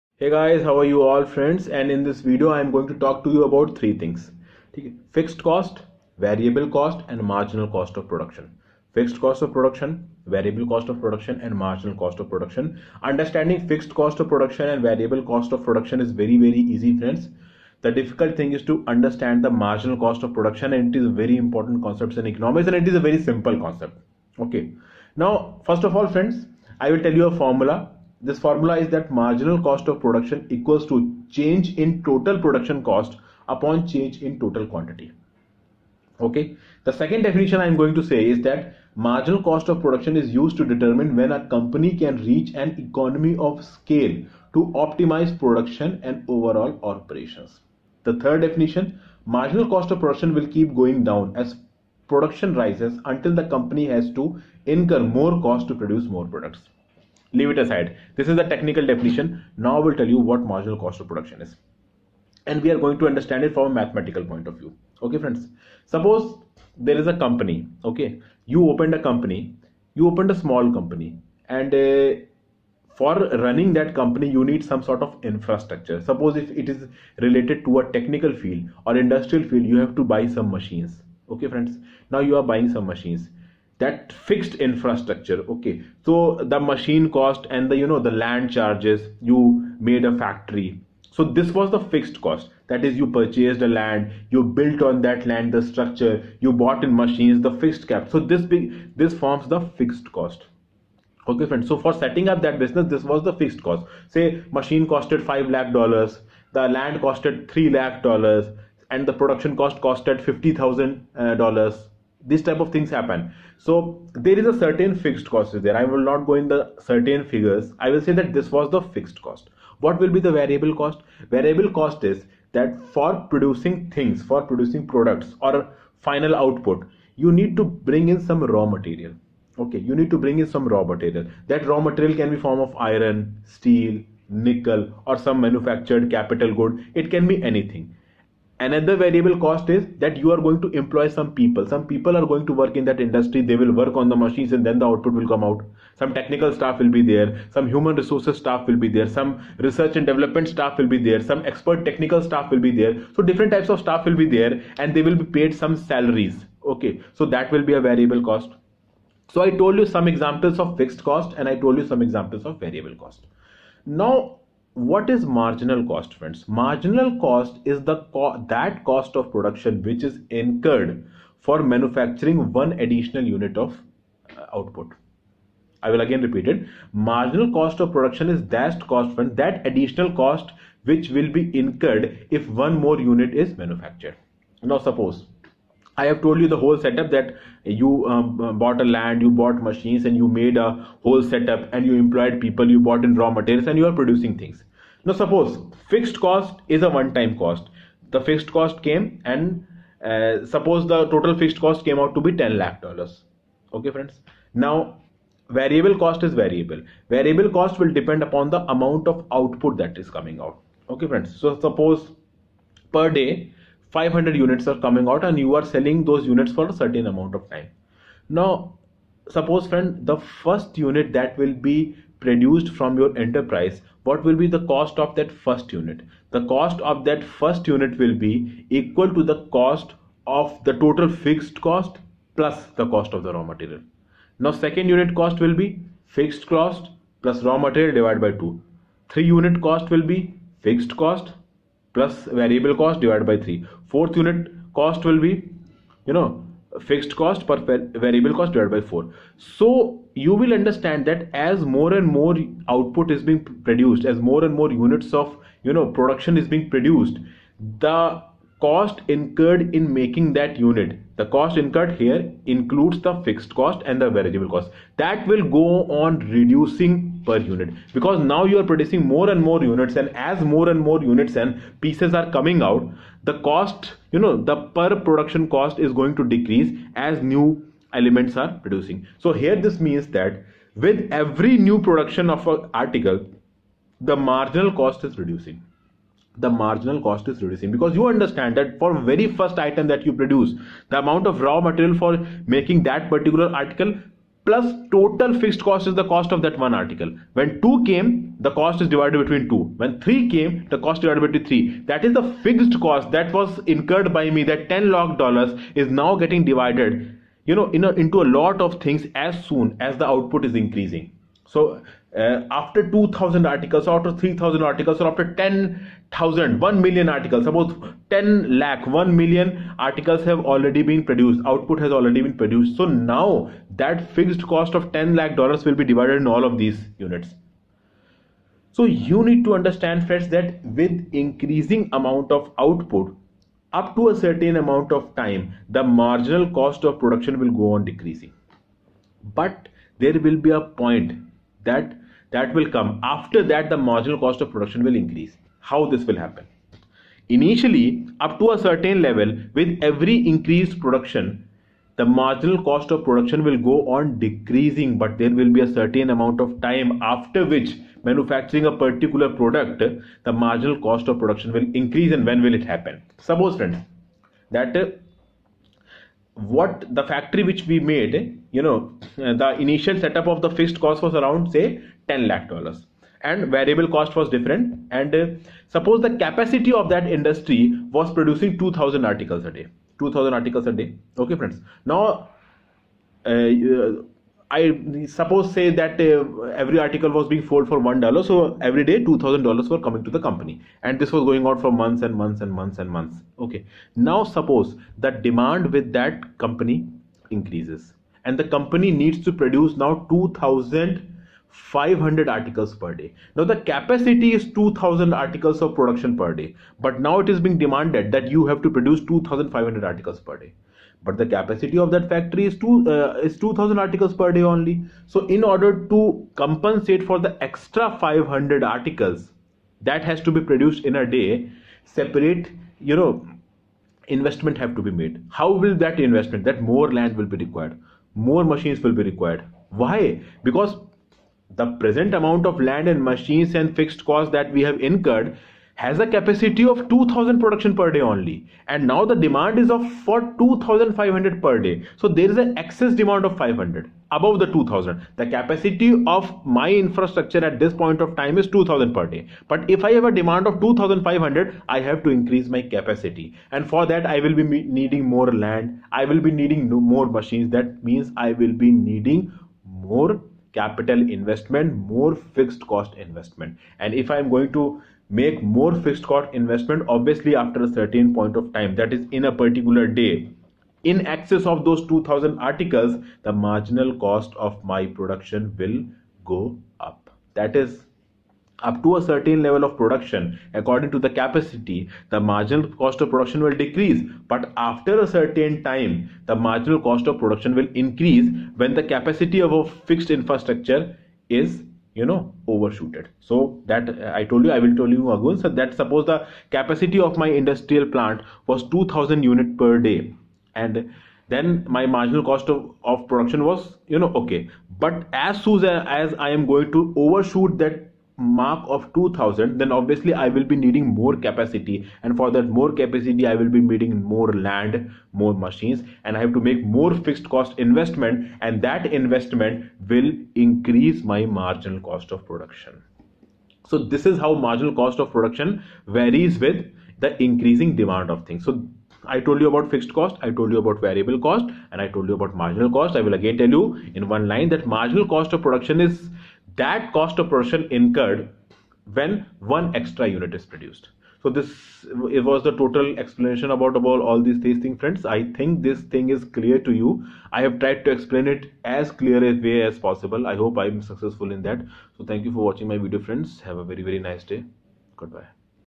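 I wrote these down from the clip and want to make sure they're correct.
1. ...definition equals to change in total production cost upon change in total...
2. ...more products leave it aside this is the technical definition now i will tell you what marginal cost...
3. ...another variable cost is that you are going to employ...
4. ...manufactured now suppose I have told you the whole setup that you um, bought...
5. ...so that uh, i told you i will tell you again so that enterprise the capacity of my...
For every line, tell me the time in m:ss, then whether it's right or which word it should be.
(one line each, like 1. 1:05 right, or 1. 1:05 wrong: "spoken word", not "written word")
1. 0:29 wrong: "production", not "definition"
2. 0:56 right
3. 2:18 right
4. 3:03 right
5. 8:13 wrong: "suppose", not "enterprise".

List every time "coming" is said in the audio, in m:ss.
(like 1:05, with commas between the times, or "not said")
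3:30, 3:34, 4:32, 6:29.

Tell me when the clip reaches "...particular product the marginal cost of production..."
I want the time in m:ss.
5:58.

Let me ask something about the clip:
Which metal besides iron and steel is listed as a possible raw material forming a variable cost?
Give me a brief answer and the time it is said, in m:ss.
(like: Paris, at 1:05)
nickel, at 2:14.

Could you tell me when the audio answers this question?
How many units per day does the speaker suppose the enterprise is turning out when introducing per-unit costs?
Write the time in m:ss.
3:33.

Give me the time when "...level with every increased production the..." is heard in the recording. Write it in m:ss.
5:49.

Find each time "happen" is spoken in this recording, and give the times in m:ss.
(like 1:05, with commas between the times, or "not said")
1:52, 5:46, 6:02.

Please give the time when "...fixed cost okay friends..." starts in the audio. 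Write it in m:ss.
1:39.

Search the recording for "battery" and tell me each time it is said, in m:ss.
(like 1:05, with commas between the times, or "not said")
not said.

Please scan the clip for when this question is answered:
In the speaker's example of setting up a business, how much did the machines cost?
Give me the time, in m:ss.
1:45.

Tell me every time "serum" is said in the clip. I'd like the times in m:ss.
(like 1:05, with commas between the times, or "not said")
not said.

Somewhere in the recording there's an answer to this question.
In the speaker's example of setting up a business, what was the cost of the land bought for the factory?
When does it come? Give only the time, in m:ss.
1:47.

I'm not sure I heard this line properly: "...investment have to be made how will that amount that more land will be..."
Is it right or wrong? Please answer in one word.
wrong.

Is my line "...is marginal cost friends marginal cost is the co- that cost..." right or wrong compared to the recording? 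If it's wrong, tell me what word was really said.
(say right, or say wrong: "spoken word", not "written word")
right.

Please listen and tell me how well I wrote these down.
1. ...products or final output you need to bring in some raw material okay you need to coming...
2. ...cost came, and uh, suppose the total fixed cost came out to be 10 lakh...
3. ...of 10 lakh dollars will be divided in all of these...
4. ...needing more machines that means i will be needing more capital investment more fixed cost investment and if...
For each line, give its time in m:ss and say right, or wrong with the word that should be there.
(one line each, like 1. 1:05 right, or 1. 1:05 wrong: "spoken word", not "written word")
1. 2:04 wrong: "bring", not "coming"
2. 3:18 right
3. 5:24 right
4. 7:36 right.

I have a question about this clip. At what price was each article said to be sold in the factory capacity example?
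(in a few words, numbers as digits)
1 dollar.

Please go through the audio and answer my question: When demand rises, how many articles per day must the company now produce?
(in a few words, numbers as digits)
2500.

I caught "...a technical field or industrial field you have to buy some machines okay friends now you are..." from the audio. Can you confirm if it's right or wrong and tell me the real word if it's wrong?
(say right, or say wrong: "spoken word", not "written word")
right.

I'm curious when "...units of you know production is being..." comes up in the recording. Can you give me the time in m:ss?
4:14.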